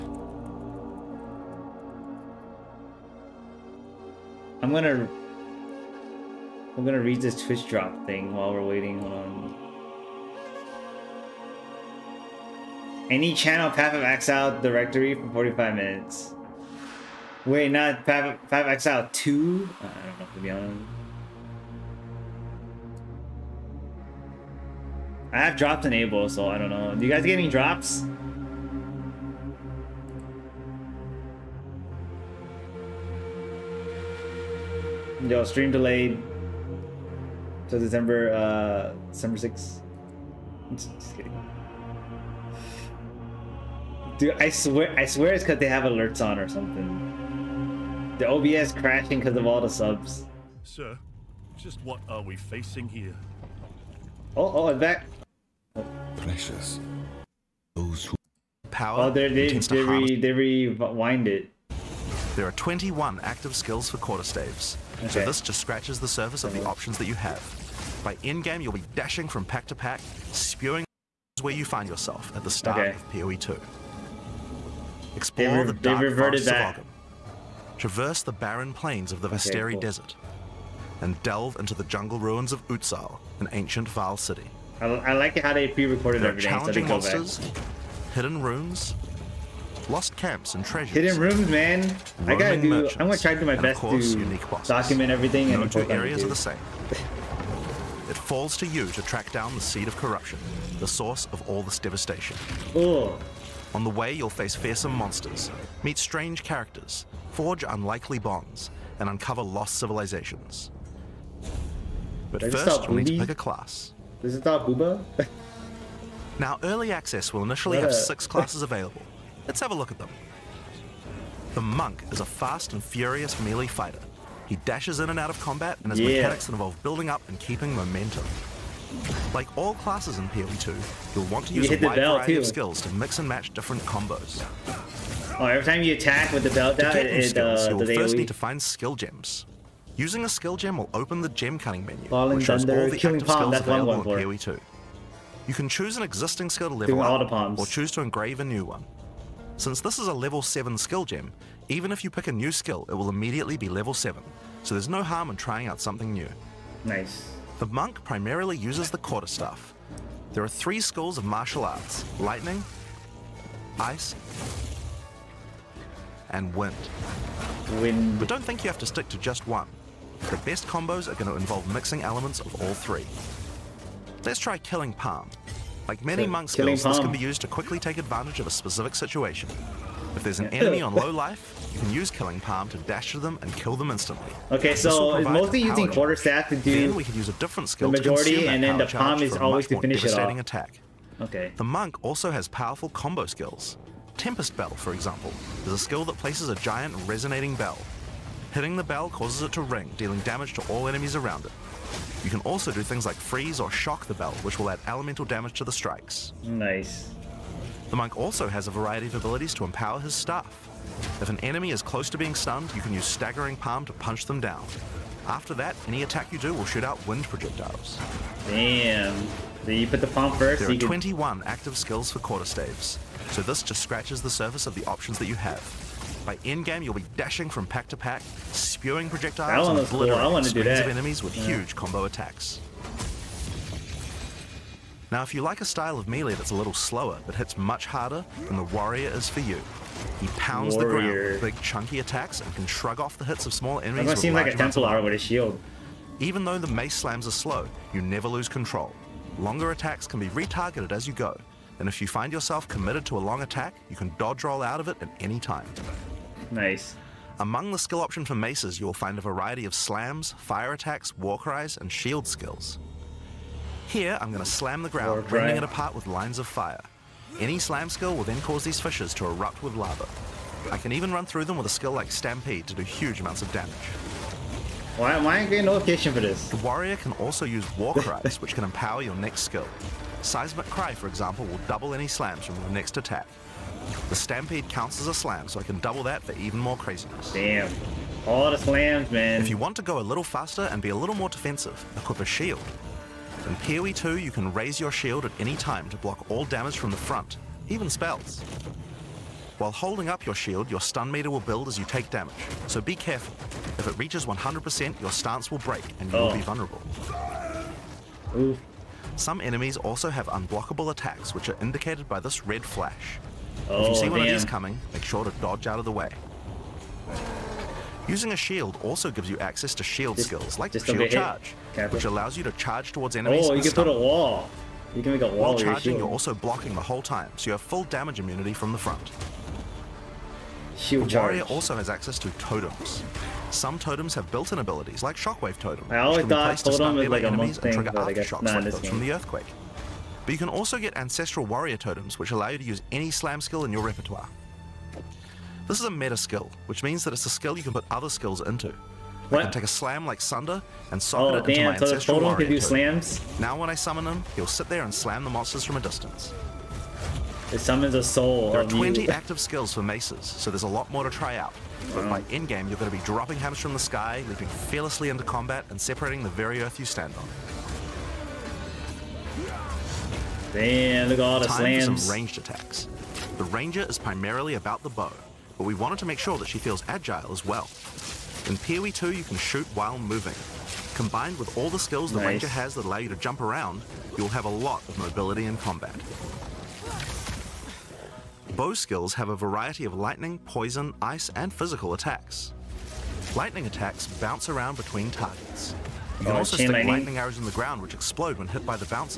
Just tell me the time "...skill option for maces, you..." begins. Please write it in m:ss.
4:17.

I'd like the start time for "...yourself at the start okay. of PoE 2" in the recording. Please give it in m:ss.
1:11.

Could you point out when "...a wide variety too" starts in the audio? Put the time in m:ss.
2:11.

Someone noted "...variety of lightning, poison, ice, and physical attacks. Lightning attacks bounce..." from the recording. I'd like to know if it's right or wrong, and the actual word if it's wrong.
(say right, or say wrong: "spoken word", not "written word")
right.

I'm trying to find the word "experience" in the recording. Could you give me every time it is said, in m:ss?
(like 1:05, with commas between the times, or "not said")
not said.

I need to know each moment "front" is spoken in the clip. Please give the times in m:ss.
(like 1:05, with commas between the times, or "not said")
4:56, 5:28.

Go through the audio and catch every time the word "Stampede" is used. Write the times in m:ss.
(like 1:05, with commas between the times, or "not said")
4:32, 4:44.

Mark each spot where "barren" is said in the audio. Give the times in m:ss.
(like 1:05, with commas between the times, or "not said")
1:18.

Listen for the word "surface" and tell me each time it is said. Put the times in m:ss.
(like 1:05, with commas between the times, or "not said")
1:06, 3:44.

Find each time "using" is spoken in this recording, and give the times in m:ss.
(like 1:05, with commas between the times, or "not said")
2:19, 3:05, 5:18.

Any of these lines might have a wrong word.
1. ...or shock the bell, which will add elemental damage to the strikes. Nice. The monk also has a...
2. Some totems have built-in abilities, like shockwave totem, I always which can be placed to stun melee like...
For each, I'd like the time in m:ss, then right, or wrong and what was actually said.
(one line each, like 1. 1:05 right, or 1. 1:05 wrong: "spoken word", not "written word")
1. 3:23 right
2. 5:33 right.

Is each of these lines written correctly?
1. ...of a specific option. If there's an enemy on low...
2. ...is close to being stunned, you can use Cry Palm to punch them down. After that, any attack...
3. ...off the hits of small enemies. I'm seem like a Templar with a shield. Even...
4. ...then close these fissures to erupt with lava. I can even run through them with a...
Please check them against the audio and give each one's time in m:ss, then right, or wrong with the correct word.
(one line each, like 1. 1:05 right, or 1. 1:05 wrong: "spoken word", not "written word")
1. 2:58 wrong: "situation", not "option"
2. 3:31 wrong: "Staggering", not "Cry"
3. 4:02 right
4. 4:28 wrong: "cause", not "close".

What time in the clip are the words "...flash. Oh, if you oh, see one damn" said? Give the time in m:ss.
5:12.